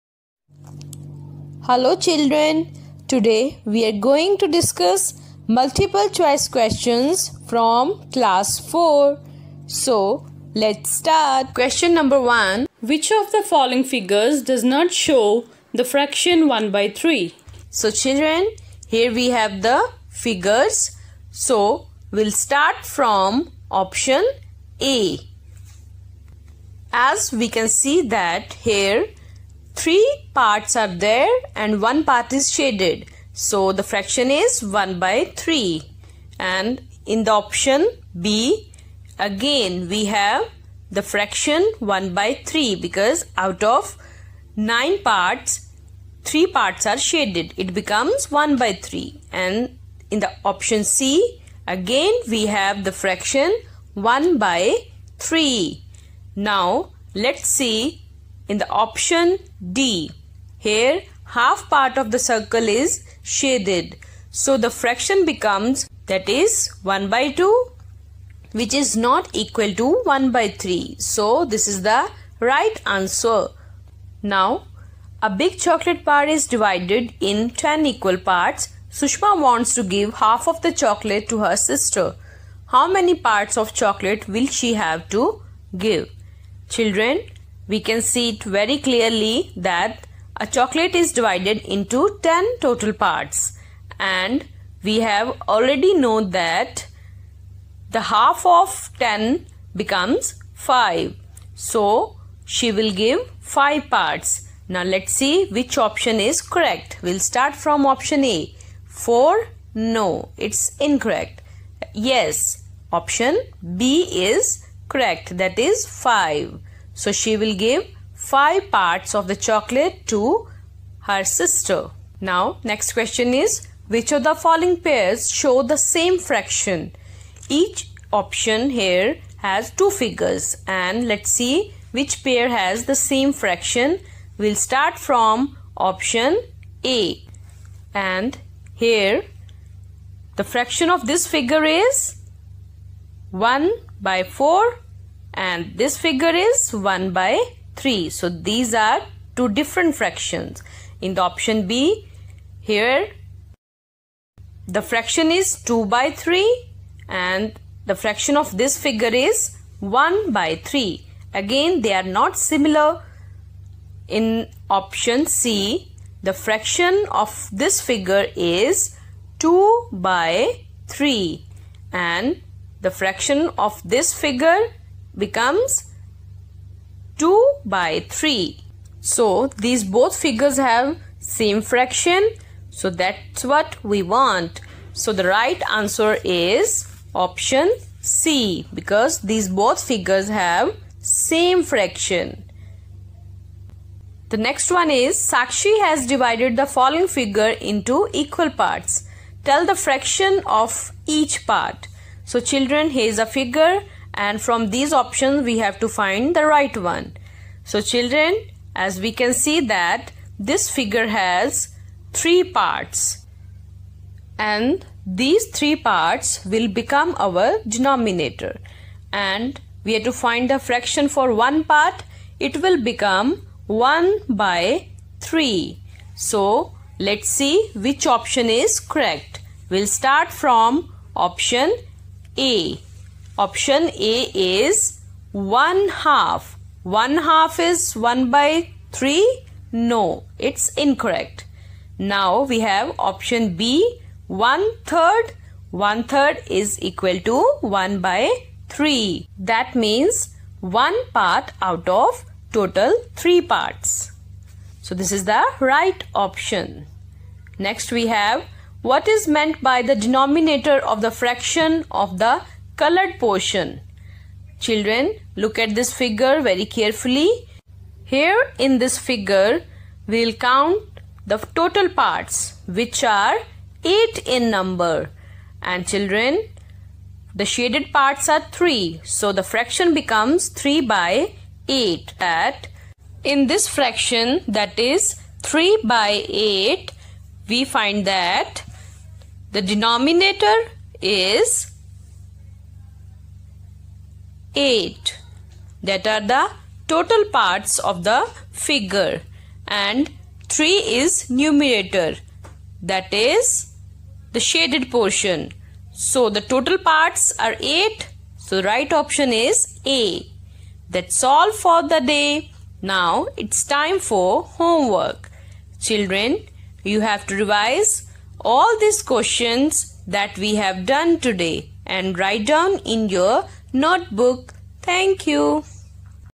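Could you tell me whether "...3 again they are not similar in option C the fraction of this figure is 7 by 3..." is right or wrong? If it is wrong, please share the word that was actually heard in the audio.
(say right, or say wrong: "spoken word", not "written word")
wrong: "2", not "7".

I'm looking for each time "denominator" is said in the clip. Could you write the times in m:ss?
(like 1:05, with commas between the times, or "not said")
3:37, 4:19, 4:49.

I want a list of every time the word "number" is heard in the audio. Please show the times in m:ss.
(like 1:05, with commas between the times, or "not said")
0:11, 4:34.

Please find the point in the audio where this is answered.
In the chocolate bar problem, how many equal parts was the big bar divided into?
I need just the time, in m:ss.
1:17.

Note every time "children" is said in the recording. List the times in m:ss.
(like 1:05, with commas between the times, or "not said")
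0:01, 0:17, 1:26, 3:22, 3:27, 4:24, 4:35, 5:15.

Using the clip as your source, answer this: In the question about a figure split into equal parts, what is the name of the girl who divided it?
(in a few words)
Sakshi.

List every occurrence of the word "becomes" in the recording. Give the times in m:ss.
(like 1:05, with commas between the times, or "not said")
0:47, 1:05, 1:39, 2:55, 3:36, 3:42, 4:39.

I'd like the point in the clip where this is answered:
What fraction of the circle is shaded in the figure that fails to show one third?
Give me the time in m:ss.
1:06.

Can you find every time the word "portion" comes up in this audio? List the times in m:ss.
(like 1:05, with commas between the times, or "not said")
4:23, 5:04.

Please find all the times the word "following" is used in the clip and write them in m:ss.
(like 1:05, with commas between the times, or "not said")
0:13, 2:04, 3:16.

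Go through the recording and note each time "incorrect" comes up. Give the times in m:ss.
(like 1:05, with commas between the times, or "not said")
1:50, 4:00.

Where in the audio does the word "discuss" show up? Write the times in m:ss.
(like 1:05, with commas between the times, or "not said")
0:04.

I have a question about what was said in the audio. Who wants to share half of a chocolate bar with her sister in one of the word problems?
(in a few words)
Sushma.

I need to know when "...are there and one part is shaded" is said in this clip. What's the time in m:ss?
0:30.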